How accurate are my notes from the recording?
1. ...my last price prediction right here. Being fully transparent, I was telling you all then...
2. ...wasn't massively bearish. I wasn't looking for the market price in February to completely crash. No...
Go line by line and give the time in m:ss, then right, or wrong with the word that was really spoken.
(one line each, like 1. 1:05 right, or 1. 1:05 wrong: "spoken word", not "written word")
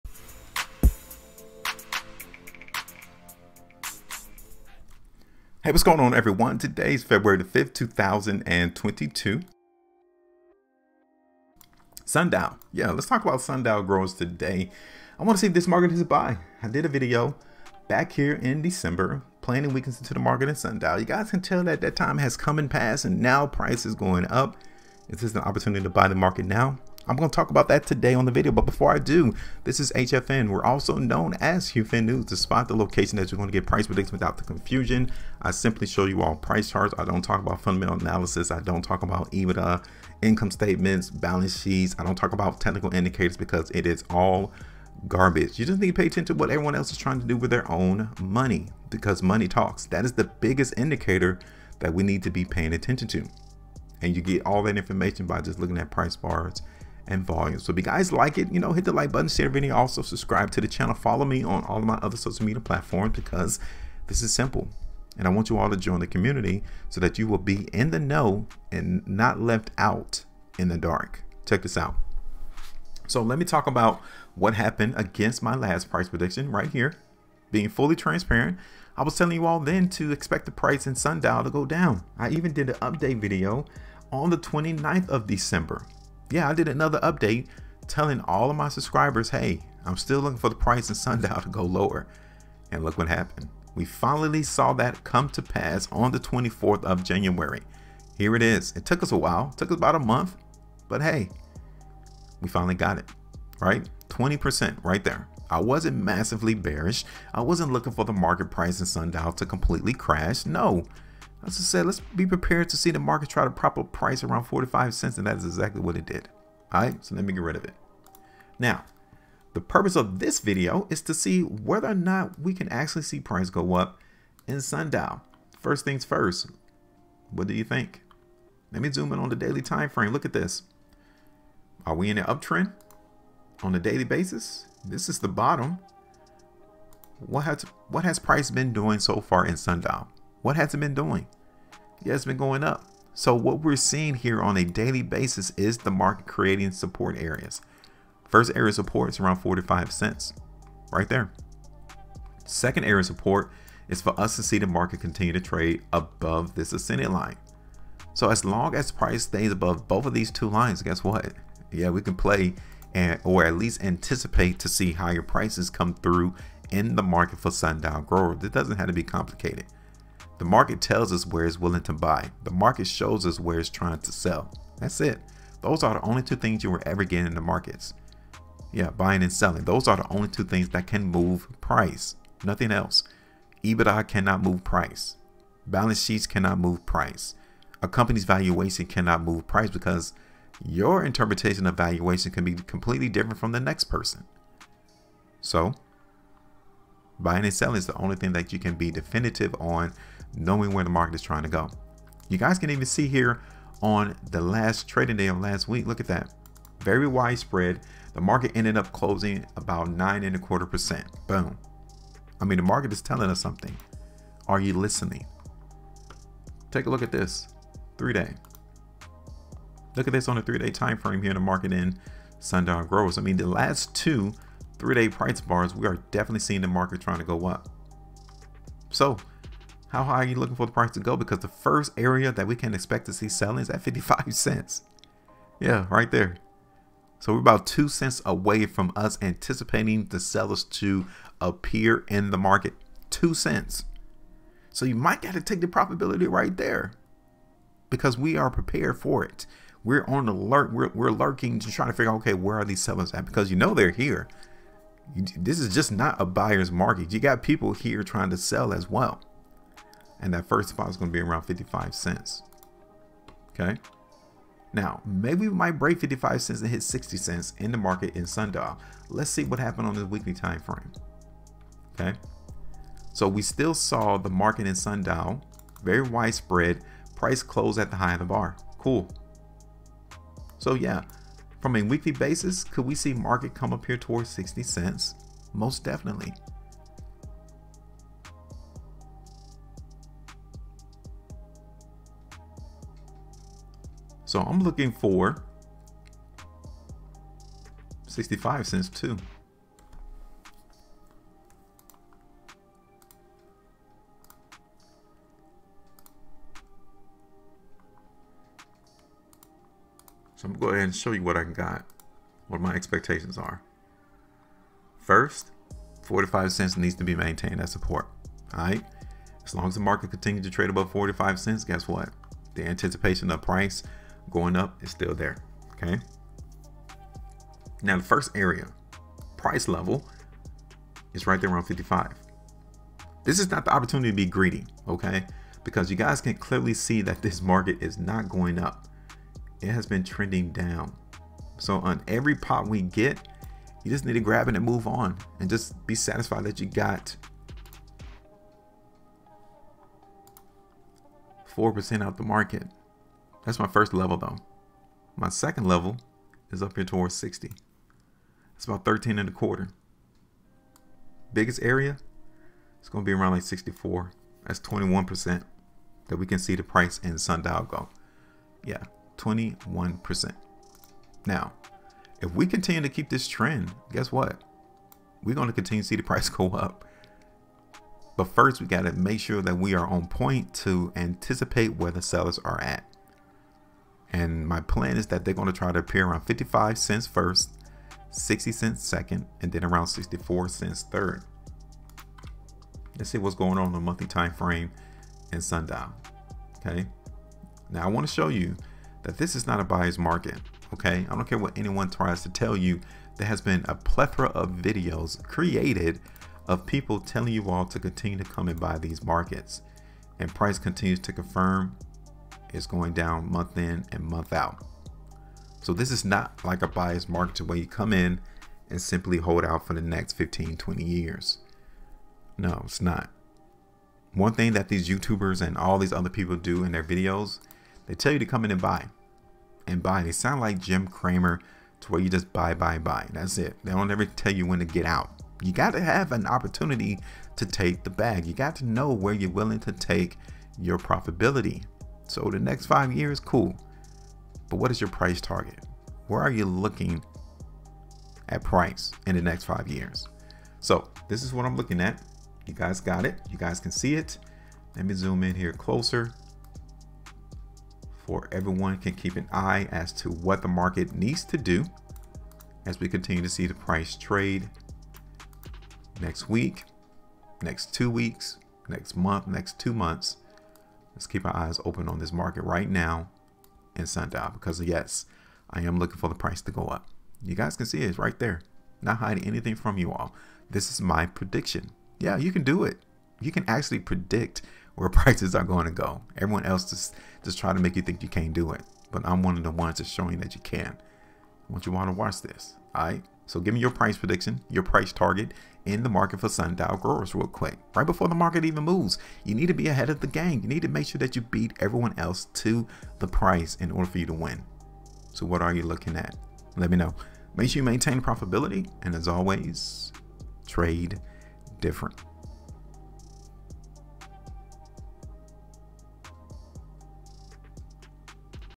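1. 1:15 right
2. 1:45 wrong: "Sundial", not "February".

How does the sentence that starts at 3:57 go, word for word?
So we're about two cents away from us anticipating the sellers to appear in the market.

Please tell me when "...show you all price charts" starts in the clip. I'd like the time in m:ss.
0:35.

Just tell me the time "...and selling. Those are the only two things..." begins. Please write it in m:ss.
2:59.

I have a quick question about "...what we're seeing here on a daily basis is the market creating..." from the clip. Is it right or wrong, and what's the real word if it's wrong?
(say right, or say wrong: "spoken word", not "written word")
right.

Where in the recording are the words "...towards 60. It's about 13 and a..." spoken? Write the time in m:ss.
5:56.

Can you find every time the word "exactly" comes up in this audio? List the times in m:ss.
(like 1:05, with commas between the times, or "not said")
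1:55.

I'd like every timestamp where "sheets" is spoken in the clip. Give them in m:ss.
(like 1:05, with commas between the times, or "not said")
0:41, 3:06.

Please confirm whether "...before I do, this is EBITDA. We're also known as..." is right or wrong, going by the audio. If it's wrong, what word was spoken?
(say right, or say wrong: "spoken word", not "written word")
wrong: "HFN", not "EBITDA".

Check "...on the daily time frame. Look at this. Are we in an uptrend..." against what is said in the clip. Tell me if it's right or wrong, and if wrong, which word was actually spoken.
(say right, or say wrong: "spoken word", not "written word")
right.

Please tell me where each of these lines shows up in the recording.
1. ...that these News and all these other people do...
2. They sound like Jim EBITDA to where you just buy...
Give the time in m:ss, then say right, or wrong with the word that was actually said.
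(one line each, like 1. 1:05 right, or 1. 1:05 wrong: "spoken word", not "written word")
1. 7:04 wrong: "YouTubers", not "News"
2. 7:10 wrong: "Cramer", not "EBITDA".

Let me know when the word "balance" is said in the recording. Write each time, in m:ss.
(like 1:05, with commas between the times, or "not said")
0:41, 3:05.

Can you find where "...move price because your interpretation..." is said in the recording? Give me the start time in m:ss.
3:09.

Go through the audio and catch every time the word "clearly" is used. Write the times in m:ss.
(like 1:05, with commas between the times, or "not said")
5:36.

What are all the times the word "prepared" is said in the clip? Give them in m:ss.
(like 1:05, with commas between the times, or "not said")
1:52, 4:08.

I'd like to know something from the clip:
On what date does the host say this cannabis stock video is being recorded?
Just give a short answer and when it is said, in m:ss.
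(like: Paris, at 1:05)
February 5th, 2022, at 0:07.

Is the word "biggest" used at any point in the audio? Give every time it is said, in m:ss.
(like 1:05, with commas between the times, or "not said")
0:50, 6:01.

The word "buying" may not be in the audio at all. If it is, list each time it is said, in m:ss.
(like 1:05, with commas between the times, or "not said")
2:58, 3:17.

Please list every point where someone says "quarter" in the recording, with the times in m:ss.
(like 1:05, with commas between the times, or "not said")
3:30, 5:59.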